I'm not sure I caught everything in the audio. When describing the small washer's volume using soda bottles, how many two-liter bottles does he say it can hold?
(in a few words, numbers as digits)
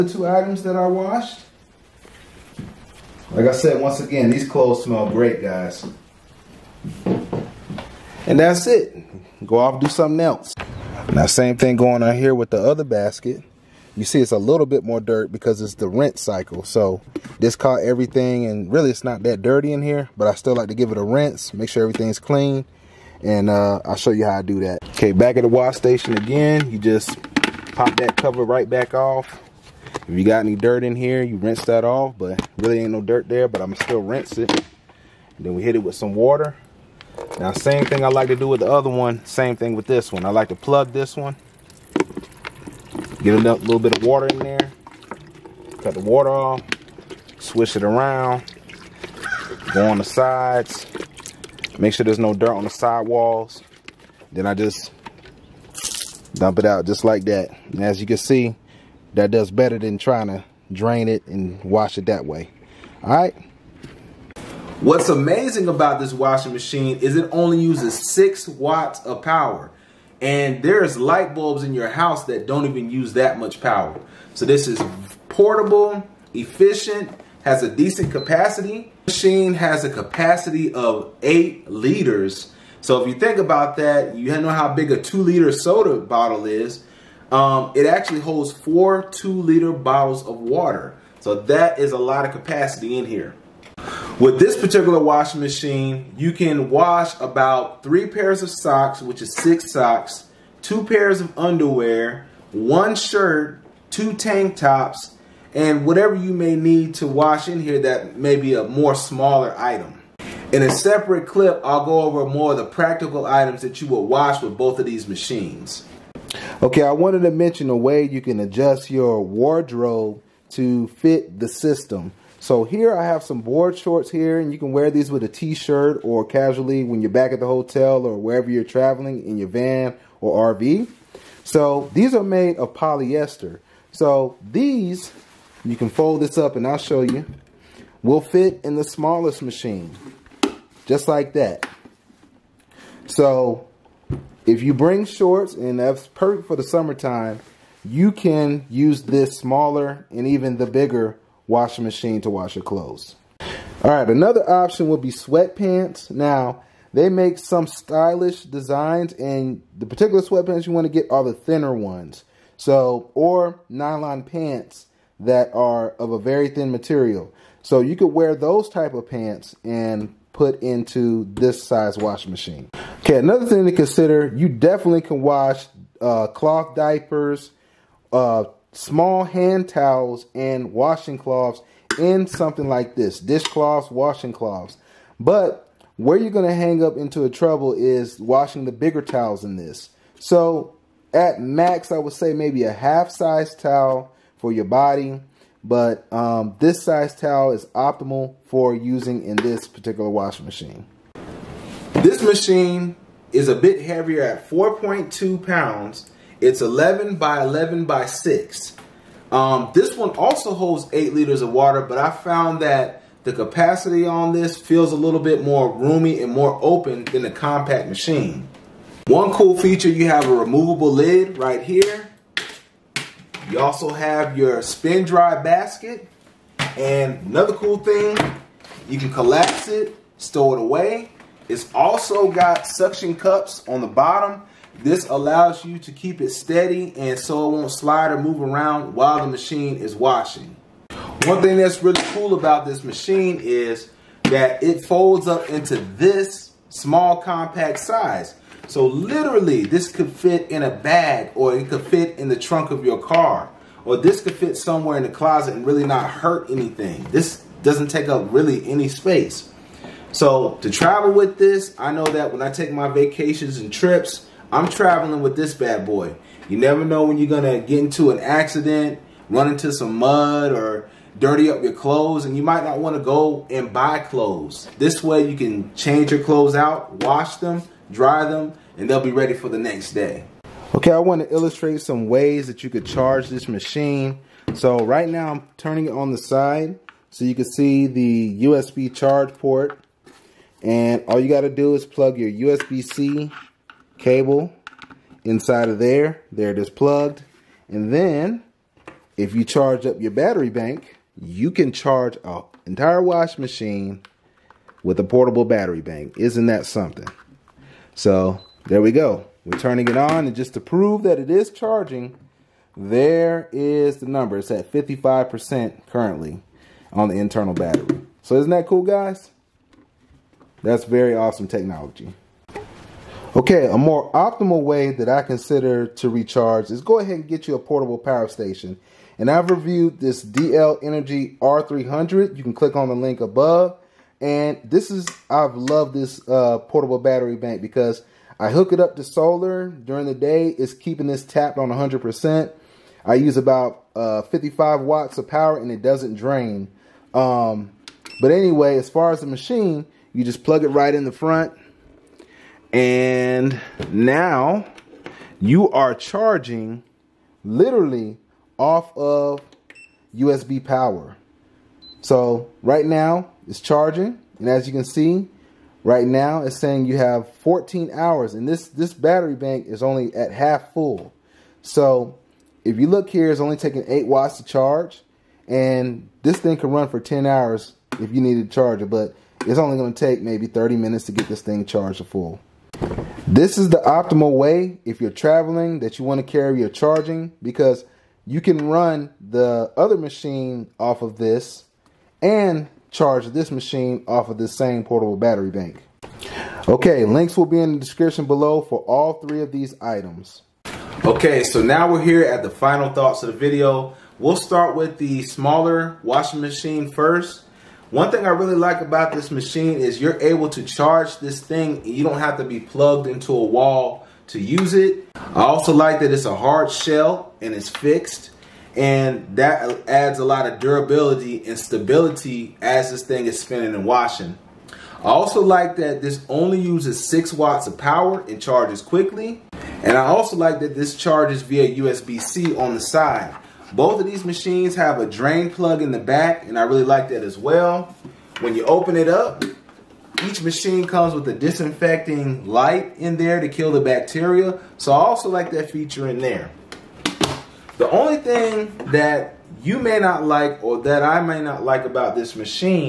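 4.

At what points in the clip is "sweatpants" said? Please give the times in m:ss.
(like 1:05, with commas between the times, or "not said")
2:35, 2:40.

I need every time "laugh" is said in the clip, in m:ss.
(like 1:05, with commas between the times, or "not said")
not said.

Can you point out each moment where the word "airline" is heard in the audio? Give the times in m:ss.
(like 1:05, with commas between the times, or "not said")
not said.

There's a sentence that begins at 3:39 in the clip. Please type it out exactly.
One cool feature, you have a removable lid right here.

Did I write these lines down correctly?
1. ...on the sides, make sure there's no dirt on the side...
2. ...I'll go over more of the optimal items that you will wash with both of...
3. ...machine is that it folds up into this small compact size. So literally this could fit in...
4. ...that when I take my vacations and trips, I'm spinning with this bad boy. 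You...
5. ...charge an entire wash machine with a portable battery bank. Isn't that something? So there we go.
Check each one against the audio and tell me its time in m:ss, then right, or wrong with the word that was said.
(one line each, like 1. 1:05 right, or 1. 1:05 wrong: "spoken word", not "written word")
1. 0:49 right
2. 1:51 wrong: "practical", not "optimal"
3. 4:02 right
4. 4:22 wrong: "traveling", not "spinning"
5. 5:01 right.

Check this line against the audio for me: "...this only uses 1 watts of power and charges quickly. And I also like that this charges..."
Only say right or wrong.
wrong.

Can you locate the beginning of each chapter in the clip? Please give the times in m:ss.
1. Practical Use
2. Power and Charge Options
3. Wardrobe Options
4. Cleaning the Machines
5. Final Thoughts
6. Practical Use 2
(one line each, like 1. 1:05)
1. 1:04
2. 4:39
3. 2:05
4. 0:10
5. 6:40
6. 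3:21.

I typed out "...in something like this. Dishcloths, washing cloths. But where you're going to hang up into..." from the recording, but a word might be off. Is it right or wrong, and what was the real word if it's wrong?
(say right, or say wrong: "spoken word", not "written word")
right.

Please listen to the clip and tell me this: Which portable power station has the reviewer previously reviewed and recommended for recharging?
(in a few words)
DL Energy R300.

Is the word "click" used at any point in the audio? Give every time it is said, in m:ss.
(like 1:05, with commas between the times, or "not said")
5:32.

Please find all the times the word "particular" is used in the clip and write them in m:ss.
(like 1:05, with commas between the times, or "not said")
1:34, 2:39, 3:19.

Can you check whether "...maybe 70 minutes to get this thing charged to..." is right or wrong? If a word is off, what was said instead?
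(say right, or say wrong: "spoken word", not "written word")
wrong: "30", not "70".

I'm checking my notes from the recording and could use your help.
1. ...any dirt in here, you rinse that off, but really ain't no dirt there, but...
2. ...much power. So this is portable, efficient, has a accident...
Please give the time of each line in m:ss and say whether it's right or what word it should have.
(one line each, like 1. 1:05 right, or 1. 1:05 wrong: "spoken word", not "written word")
1. 0:30 right
2. 1:13 wrong: "decent", not "accident".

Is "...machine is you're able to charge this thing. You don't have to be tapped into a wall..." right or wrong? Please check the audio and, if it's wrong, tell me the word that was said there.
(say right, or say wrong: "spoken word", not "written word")
wrong: "plugged", not "tapped".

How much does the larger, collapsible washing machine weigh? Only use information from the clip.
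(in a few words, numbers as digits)
4.2 pounds.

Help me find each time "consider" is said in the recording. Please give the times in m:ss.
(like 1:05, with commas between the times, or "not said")
2:53, 5:25.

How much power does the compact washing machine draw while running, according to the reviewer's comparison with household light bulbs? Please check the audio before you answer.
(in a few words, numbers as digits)
6 watts.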